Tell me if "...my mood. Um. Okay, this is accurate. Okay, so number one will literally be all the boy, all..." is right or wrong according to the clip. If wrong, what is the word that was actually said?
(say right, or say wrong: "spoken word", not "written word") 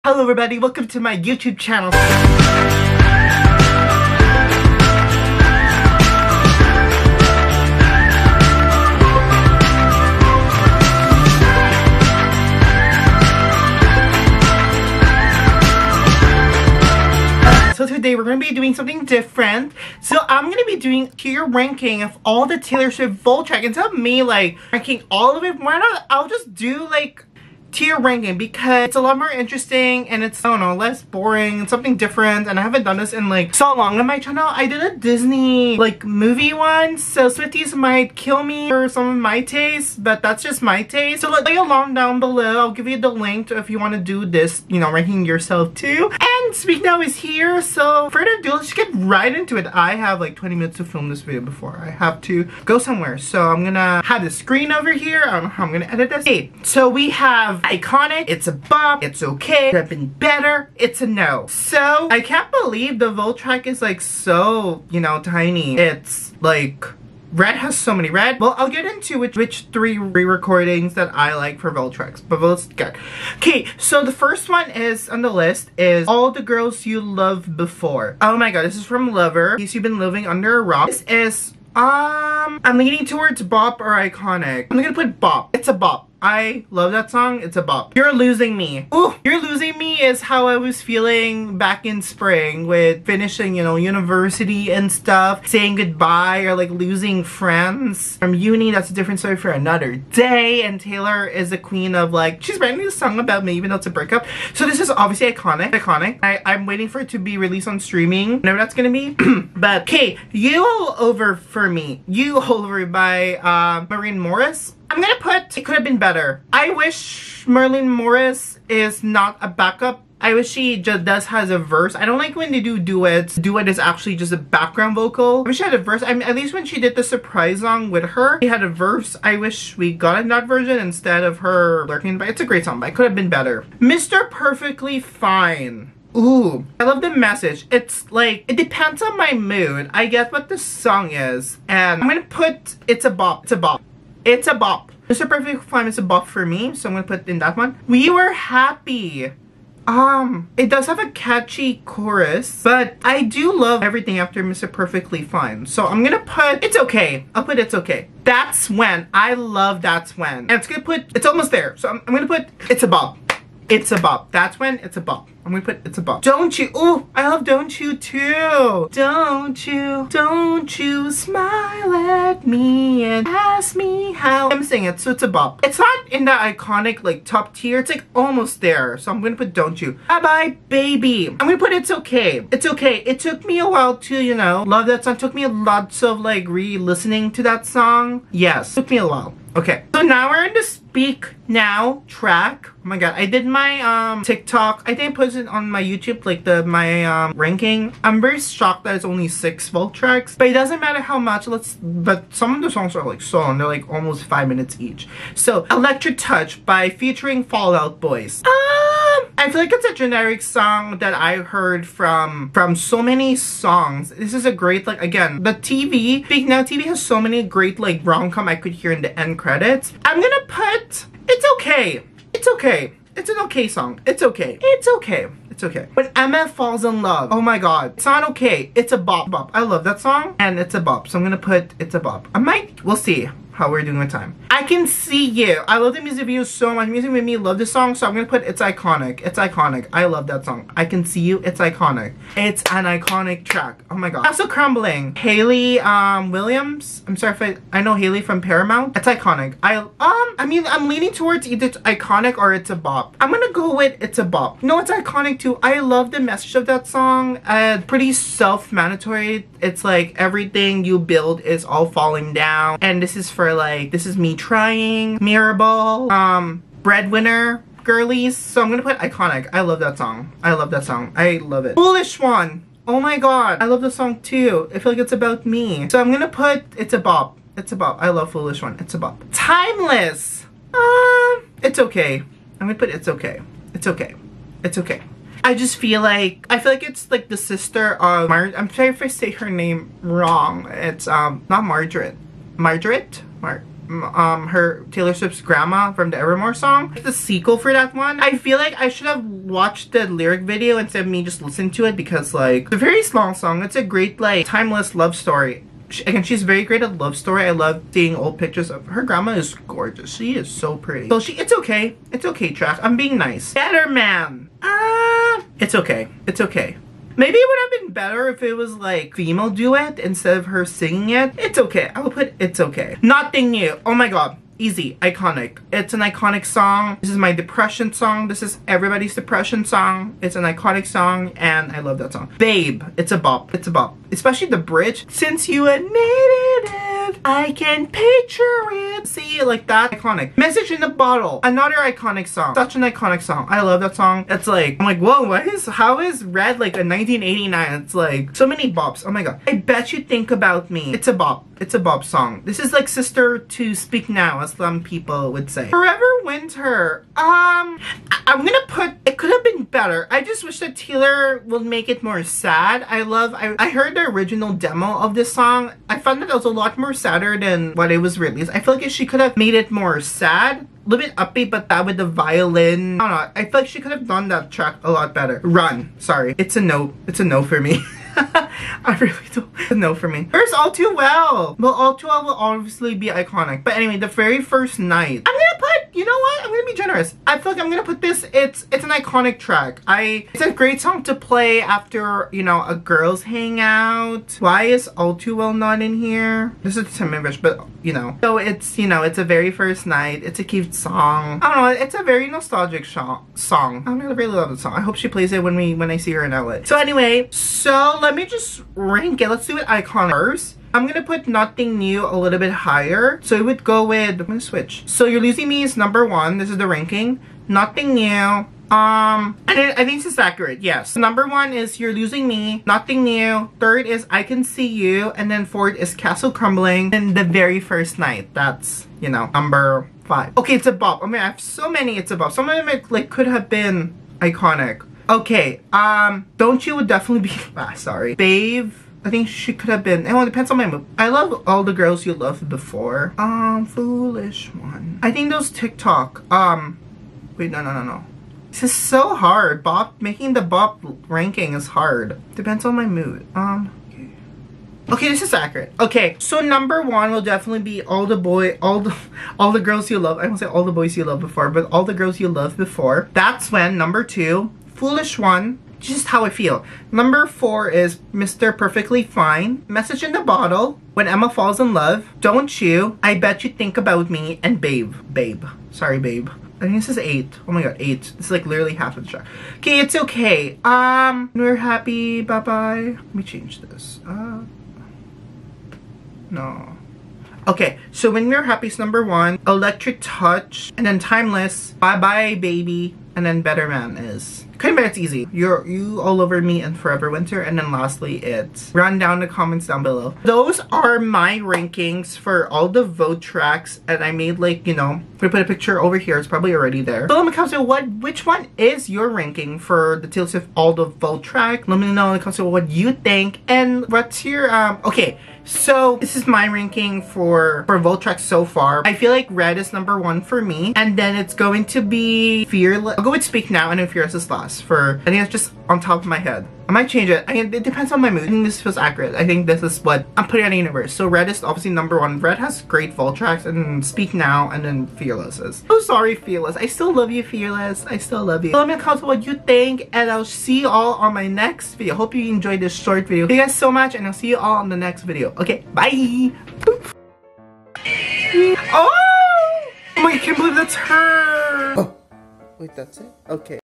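wrong: "definitely", not "literally".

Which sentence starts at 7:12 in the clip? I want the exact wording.
Some of them, it, like, could have been iconic.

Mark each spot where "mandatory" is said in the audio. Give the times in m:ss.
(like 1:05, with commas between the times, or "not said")
4:18.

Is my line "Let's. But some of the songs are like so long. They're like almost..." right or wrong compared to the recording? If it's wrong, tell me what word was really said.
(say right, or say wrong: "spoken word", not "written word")
right.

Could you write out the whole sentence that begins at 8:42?
I'll go with Speak Now and then Fearless is last.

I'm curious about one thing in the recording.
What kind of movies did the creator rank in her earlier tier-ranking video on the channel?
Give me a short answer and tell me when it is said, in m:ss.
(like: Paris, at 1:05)
Disney, at 0:34.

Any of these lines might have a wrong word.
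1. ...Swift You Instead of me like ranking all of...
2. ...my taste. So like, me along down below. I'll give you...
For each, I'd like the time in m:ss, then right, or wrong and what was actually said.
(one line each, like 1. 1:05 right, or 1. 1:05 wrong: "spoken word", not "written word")
1. 0:22 wrong: "Vault", not "You"
2. 0:40 right.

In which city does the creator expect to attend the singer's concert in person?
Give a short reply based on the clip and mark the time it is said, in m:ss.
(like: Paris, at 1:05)
LA, at 6:46.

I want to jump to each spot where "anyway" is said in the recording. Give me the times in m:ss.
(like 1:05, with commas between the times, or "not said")
6:23, 6:46.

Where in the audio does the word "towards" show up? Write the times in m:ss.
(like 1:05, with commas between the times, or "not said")
1:23, 4:11.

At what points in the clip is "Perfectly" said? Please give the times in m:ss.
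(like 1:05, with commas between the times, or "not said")
2:14, 2:25, 2:34, 7:48.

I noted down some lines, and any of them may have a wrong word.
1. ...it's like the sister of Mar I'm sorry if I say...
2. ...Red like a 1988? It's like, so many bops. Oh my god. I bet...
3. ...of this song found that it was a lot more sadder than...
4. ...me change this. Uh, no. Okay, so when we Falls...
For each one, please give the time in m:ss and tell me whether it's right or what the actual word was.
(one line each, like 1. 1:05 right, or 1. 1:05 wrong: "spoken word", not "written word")
1. 4:46 right
2. 5:46 wrong: "1989", not "1988"
3. 6:04 right
4. 8:03 wrong: "Windmere", not "Falls".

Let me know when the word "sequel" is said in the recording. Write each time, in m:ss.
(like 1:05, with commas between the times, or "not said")
4:57.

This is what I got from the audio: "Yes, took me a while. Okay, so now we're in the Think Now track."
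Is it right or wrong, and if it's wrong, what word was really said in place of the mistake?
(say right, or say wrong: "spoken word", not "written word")
wrong: "Speak", not "Think".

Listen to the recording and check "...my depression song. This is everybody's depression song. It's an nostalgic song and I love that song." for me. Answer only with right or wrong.
wrong.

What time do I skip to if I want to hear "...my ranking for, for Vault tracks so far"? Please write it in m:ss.
8:36.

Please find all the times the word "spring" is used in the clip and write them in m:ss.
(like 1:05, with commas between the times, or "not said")
1:32.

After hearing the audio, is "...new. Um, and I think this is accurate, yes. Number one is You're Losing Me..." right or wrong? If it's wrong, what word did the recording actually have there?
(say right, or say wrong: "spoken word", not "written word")
right.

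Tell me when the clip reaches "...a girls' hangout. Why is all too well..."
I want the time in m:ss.
6:32.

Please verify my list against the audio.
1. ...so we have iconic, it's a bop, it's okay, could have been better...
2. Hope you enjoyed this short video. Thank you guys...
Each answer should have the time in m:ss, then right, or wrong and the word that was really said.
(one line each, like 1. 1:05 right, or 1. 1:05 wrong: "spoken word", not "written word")
1. 0:56 right
2. 9:01 right.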